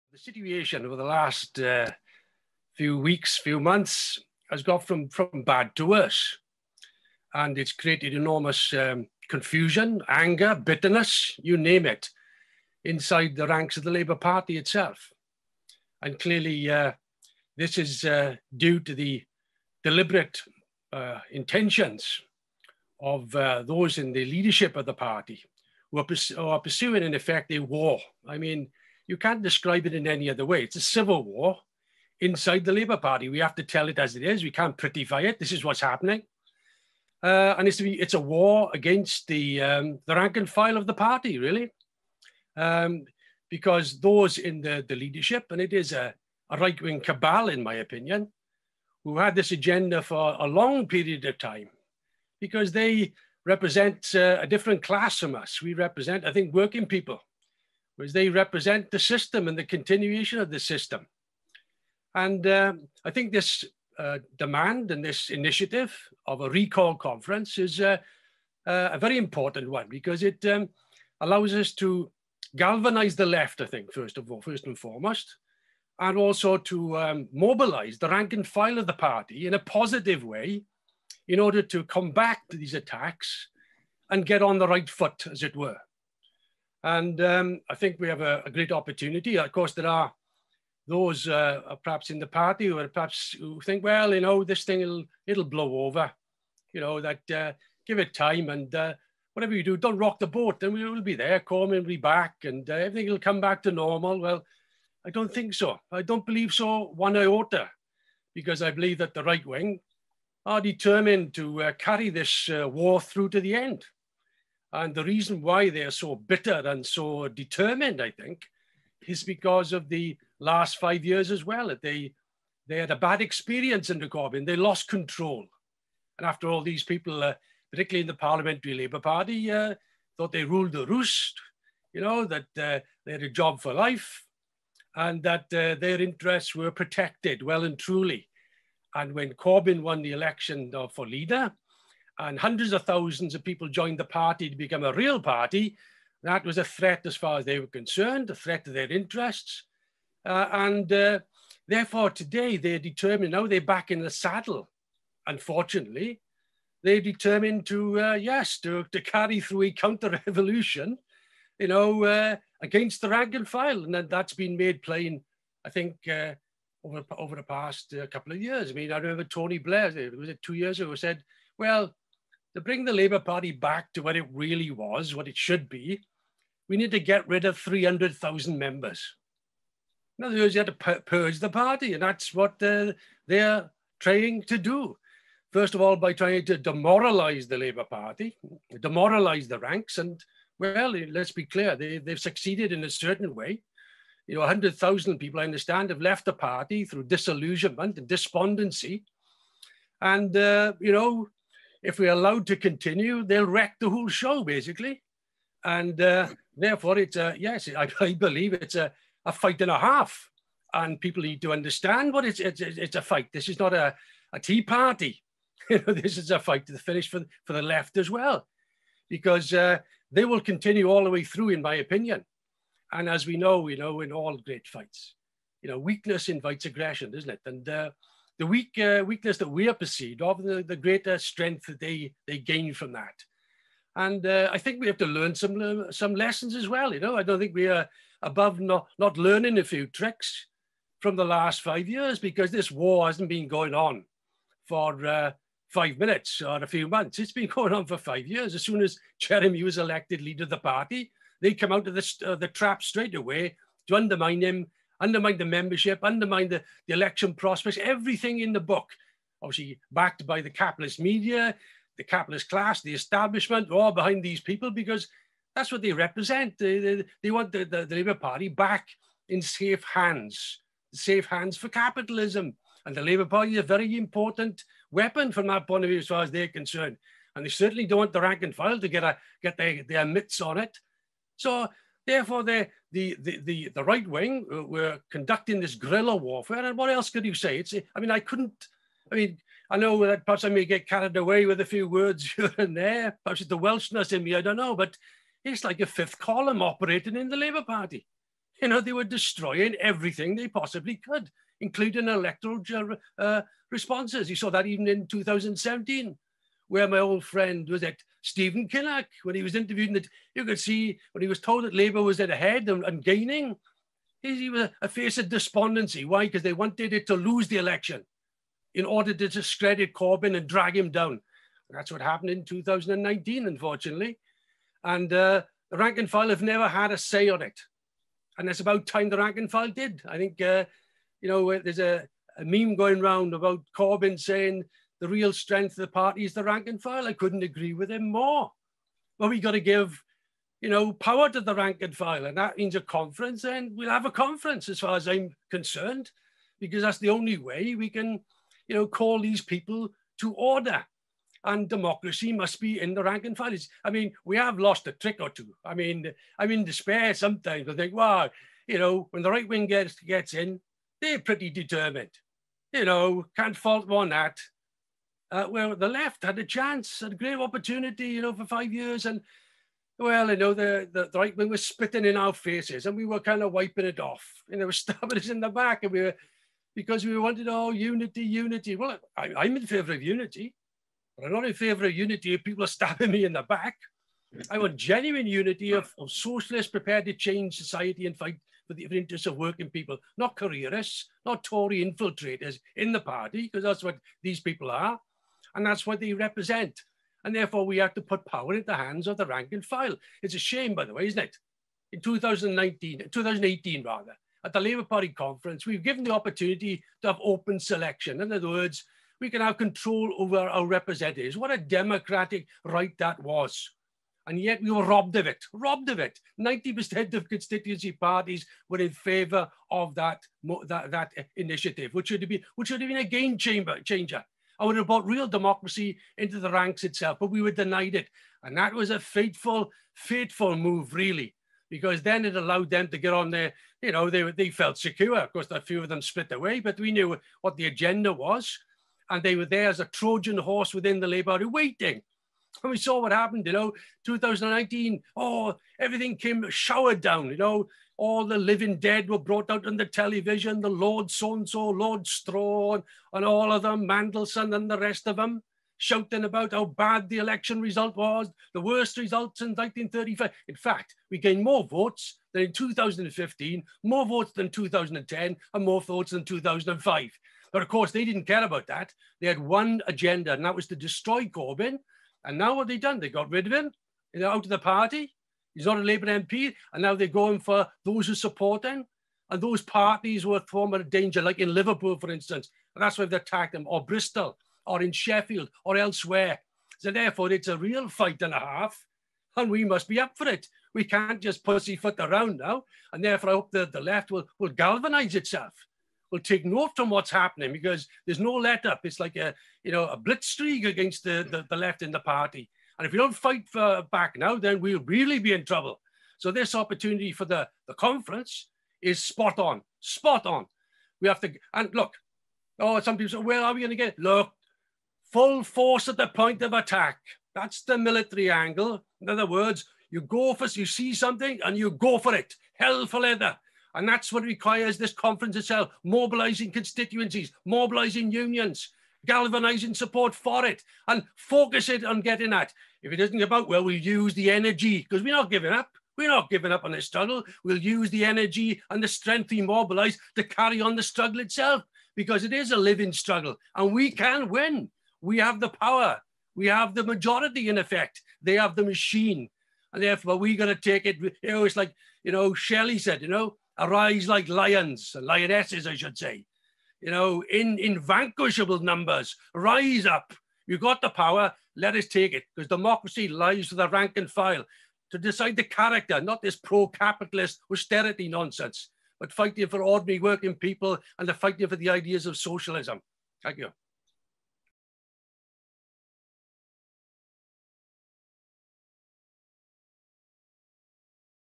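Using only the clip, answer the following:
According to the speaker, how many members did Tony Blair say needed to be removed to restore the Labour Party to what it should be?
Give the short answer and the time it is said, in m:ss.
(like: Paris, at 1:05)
300,000, at 2:57.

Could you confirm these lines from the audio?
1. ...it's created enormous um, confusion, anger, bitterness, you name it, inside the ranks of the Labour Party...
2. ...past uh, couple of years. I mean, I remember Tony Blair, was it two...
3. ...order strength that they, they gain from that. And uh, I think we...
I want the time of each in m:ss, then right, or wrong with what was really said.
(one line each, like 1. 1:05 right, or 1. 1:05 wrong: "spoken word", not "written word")
1. 0:07 right
2. 2:47 right
3. 3:50 wrong: "greater", not "order".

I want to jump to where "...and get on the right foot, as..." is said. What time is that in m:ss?
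1:24.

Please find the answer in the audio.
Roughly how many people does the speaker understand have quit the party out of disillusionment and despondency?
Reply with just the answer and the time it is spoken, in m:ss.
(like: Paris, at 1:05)
100,000, at 3:14.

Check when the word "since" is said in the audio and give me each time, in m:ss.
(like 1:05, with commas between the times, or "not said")
7:39.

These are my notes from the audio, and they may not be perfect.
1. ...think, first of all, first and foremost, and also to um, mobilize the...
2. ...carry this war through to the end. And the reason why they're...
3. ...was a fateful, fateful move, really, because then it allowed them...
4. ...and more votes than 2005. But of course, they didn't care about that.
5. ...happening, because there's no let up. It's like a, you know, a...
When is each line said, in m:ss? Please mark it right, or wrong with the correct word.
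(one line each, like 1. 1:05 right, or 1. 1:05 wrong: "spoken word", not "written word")
1. 1:13 right
2. 1:51 right
3. 7:08 right
4. 7:45 right
5. 8:17 right.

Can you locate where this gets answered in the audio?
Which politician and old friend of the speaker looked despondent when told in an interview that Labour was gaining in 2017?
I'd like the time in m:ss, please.
5:08.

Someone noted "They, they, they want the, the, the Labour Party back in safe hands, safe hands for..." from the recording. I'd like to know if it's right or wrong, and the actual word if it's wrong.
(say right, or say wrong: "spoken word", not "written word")
right.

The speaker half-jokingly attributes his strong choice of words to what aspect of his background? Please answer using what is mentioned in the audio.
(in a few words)
Welshness.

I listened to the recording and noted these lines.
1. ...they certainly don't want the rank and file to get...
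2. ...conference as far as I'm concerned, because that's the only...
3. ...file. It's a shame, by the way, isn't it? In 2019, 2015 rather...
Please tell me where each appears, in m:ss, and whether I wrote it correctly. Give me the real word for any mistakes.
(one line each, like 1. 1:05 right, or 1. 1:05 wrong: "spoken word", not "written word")
1. 4:37 right
2. 5:44 right
3. 6:39 wrong: "2018", not "2015".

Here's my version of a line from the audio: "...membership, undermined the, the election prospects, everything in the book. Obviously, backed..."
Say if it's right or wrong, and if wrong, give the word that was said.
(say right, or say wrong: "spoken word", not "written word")
right.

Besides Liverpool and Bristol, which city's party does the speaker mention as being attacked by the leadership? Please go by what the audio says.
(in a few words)
Sheffield.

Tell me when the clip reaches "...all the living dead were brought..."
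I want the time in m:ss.
7:28.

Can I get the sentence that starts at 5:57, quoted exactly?
I think, wow, you know, when the right wing gets gets in, they're pretty determined.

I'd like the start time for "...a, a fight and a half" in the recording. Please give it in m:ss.
3:28.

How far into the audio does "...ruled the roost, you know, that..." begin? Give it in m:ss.
2:10.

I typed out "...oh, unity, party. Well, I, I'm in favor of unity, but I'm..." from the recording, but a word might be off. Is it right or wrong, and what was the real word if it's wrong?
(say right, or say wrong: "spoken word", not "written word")
wrong: "unity", not "party".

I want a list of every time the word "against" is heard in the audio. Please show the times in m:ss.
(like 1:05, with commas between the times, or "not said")
0:38, 2:42, 8:20.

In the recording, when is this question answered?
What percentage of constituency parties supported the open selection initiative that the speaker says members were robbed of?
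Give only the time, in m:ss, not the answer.
6:56.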